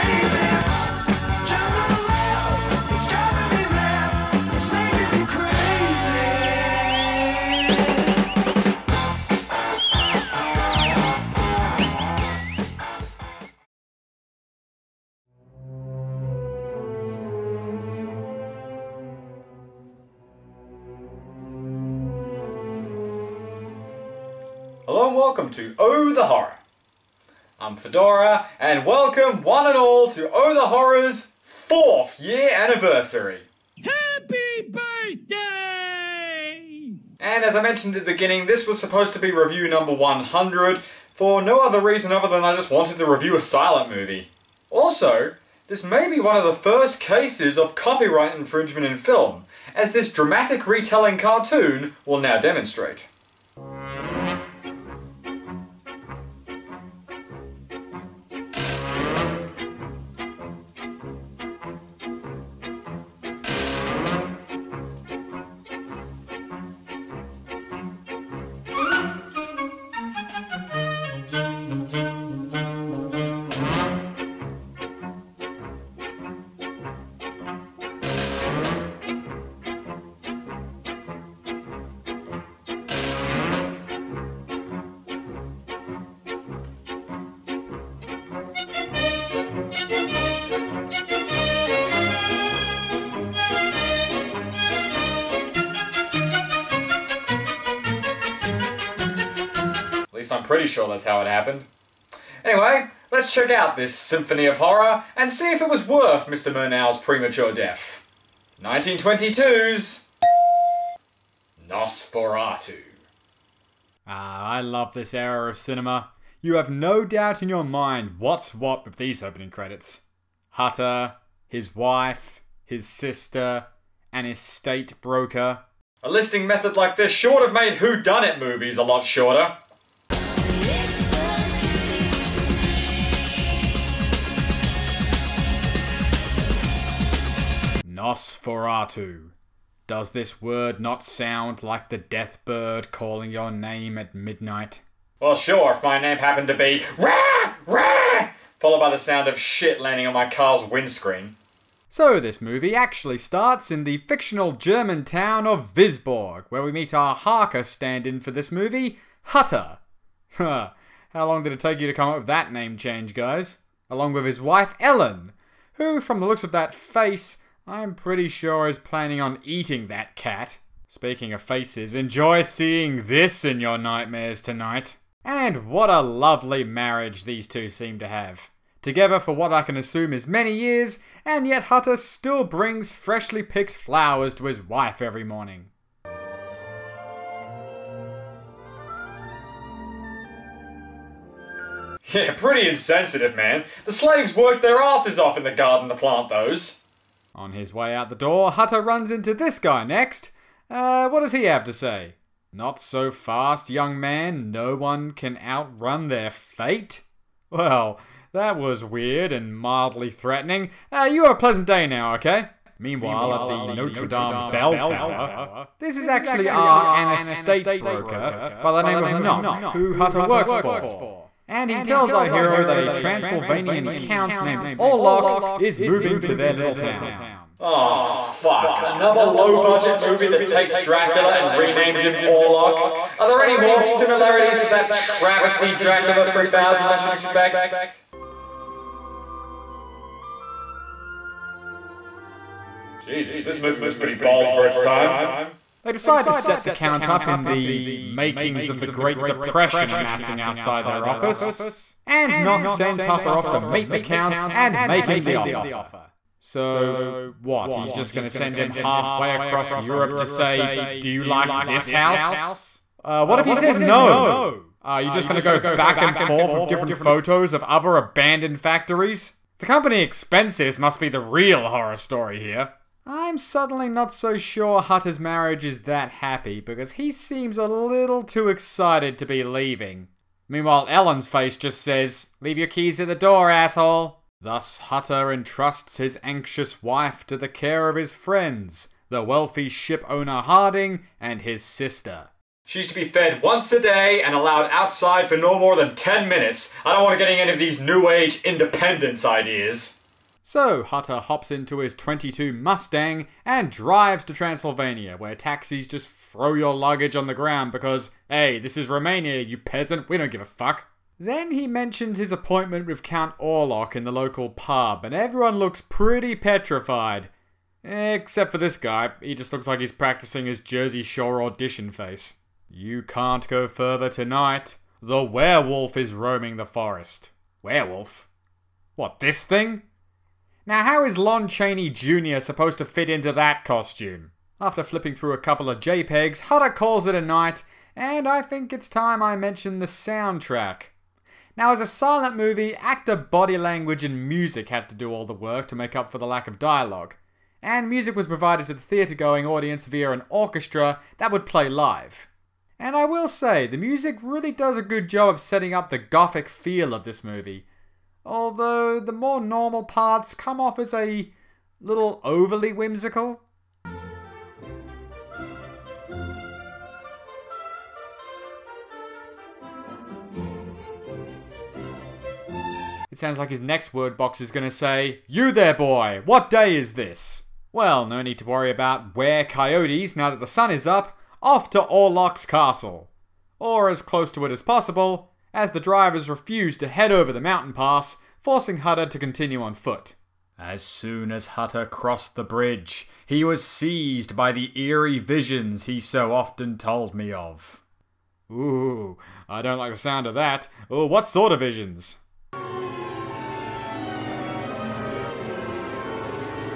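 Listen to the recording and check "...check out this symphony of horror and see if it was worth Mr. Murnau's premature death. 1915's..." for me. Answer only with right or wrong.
wrong.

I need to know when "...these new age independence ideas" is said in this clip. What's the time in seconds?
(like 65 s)
297 s.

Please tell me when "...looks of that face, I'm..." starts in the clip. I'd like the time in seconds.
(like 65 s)
166 s.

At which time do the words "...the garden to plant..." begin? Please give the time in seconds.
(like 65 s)
195 s.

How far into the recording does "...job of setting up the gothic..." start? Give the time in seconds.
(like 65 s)
355 s.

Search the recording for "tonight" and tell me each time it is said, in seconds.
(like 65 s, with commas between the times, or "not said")
174 s, 324 s.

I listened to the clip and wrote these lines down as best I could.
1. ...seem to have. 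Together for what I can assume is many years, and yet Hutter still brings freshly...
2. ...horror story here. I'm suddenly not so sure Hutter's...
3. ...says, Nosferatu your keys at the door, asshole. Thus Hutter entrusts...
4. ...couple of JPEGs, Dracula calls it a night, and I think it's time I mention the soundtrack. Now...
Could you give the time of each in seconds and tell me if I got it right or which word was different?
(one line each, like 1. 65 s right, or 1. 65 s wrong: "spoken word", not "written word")
1. 177 s right
2. 271 s right
3. 281 s wrong: "Leave", not "Nosferatu"
4. 335 s wrong: "Hutter", not "Dracula".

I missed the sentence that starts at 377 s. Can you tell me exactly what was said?
Well, no need to worry about where coyotes now that the sun is up, off to Orlok's castle.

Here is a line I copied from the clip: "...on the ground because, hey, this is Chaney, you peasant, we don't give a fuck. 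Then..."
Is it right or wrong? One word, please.
wrong.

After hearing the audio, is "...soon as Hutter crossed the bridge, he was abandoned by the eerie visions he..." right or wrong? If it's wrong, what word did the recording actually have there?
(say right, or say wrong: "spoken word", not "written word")
wrong: "seized", not "abandoned".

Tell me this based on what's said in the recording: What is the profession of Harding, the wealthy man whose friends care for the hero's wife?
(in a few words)
Ship owner.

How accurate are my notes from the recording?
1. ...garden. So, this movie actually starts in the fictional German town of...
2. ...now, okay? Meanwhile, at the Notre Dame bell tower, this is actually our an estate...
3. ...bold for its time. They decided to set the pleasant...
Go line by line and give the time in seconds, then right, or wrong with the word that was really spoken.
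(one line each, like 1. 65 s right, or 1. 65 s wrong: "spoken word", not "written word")
1. 150 s wrong: "windscreen", not "garden"
2. 211 s right
3. 244 s wrong: "count", not "pleasant".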